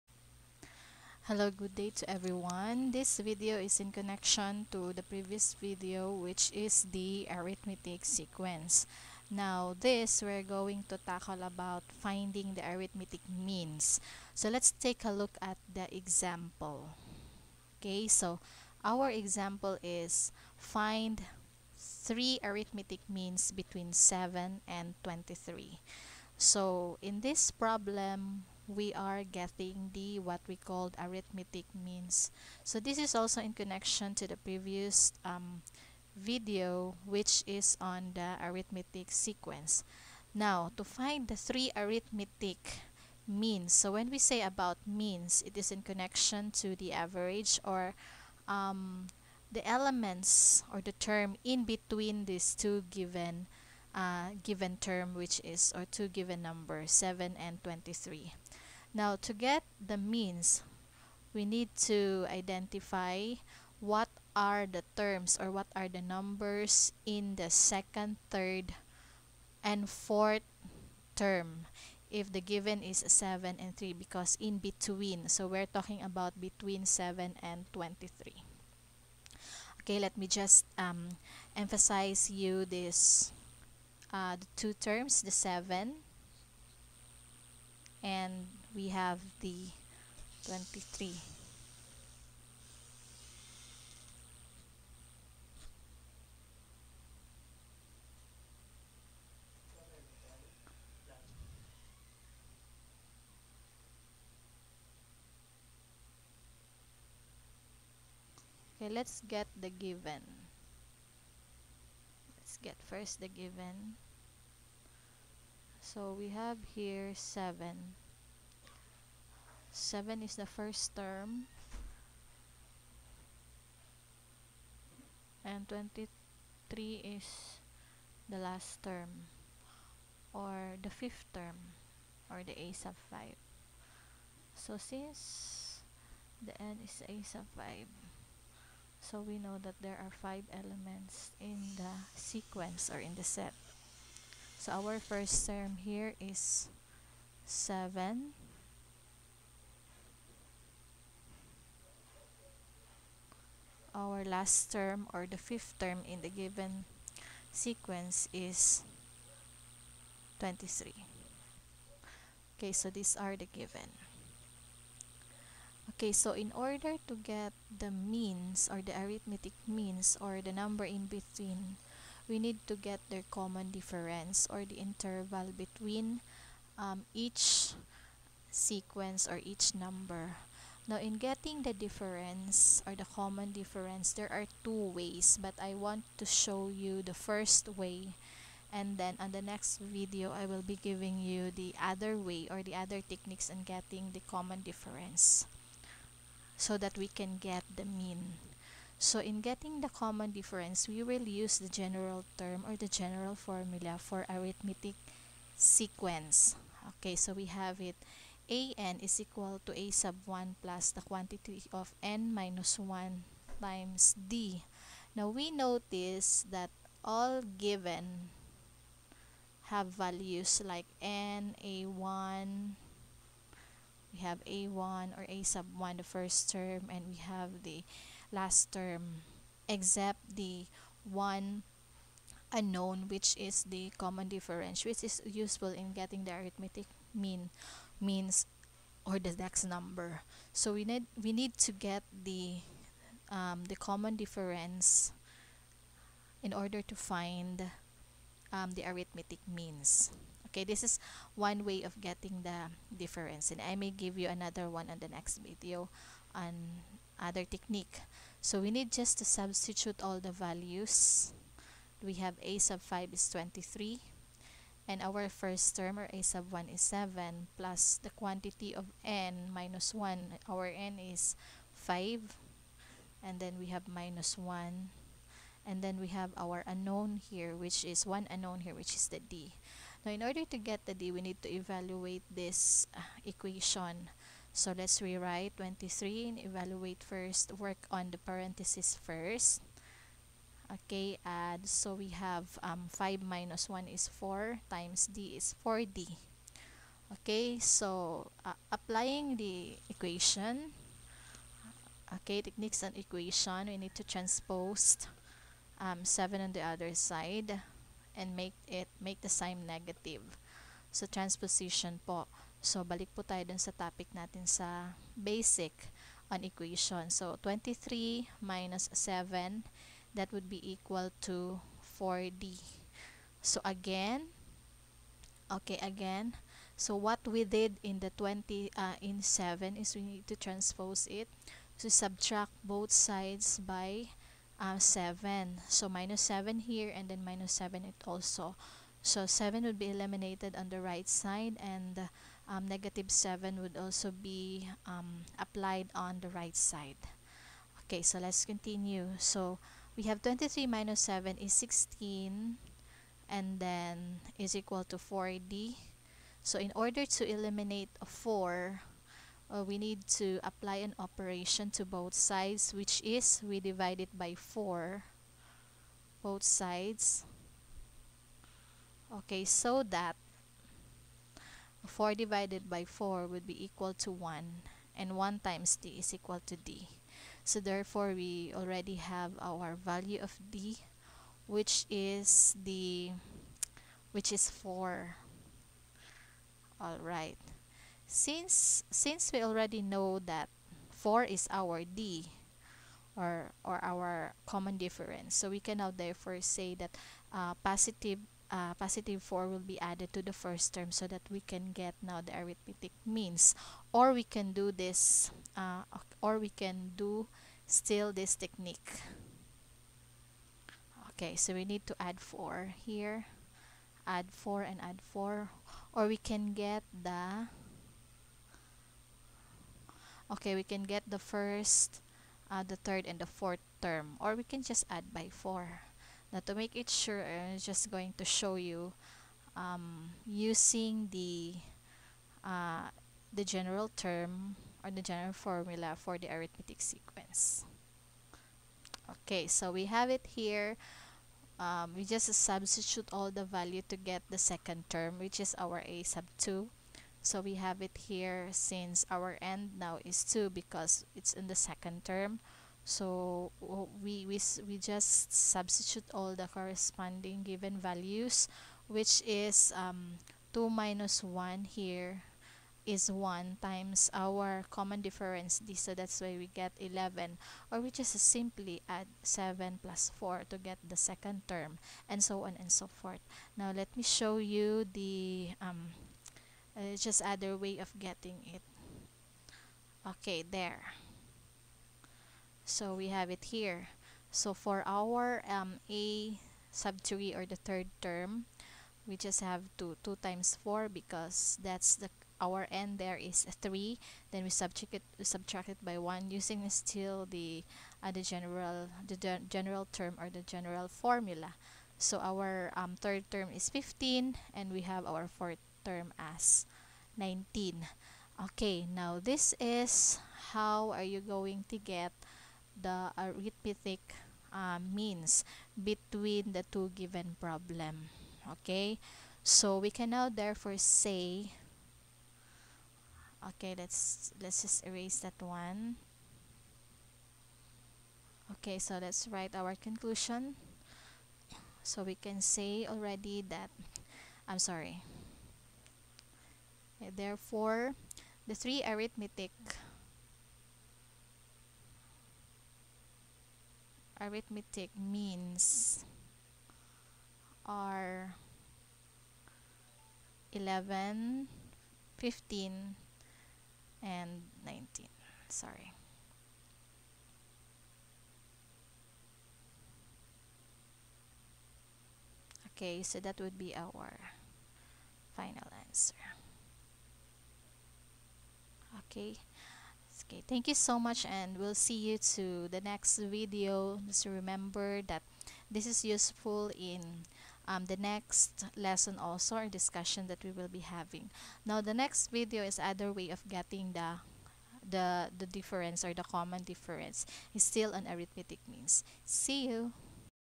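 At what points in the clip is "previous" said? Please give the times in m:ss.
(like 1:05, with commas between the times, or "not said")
0:05, 0:34.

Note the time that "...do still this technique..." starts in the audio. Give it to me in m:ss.
6:46.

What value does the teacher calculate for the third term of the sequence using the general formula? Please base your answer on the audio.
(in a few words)
15.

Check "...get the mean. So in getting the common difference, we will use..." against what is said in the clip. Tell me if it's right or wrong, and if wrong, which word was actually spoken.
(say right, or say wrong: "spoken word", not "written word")
right.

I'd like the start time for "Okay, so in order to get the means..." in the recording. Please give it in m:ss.
2:45.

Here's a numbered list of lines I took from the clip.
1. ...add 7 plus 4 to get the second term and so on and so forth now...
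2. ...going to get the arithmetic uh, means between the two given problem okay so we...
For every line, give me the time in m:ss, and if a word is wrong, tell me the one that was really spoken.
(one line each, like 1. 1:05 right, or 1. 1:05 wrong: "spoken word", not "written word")
1. 7:48 right
2. 8:31 right.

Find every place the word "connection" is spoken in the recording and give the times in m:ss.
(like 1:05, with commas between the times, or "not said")
0:03, 0:33, 0:45.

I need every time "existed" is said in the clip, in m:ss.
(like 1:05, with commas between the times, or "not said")
not said.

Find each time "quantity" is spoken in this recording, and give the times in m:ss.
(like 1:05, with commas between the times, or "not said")
3:31, 4:28.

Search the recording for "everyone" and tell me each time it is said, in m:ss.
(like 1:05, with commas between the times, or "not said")
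0:02.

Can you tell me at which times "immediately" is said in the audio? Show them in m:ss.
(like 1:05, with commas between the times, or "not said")
not said.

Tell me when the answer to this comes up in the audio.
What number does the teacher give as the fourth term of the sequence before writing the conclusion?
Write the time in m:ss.
8:25.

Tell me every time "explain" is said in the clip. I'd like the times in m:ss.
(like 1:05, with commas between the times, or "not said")
not said.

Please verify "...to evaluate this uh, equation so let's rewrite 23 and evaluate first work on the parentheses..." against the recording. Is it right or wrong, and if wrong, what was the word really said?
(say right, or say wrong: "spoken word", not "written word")
right.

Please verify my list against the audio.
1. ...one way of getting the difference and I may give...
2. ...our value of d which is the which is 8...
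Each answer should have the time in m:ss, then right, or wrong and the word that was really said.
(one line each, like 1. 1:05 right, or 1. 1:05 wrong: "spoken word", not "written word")
1. 4:11 right
2. 6:19 wrong: "4", not "8".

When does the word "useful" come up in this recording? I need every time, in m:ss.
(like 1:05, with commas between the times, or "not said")
3:55, 9:36.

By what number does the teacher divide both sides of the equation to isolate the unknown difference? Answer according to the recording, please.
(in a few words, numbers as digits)
4.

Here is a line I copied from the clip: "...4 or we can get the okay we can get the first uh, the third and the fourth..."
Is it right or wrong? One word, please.
right.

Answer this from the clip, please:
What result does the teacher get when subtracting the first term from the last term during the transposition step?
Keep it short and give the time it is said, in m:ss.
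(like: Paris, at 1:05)
16, at 5:50.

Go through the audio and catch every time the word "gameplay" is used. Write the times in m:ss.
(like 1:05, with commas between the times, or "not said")
not said.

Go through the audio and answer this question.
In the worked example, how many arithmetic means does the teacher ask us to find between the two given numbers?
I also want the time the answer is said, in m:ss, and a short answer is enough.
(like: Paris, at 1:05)
3, at 0:21.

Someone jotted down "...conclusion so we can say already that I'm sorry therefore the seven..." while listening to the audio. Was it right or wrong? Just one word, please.
wrong.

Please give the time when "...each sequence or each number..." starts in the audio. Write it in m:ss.
2:57.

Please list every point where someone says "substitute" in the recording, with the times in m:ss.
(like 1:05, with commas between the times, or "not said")
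4:19, 7:22, 7:35.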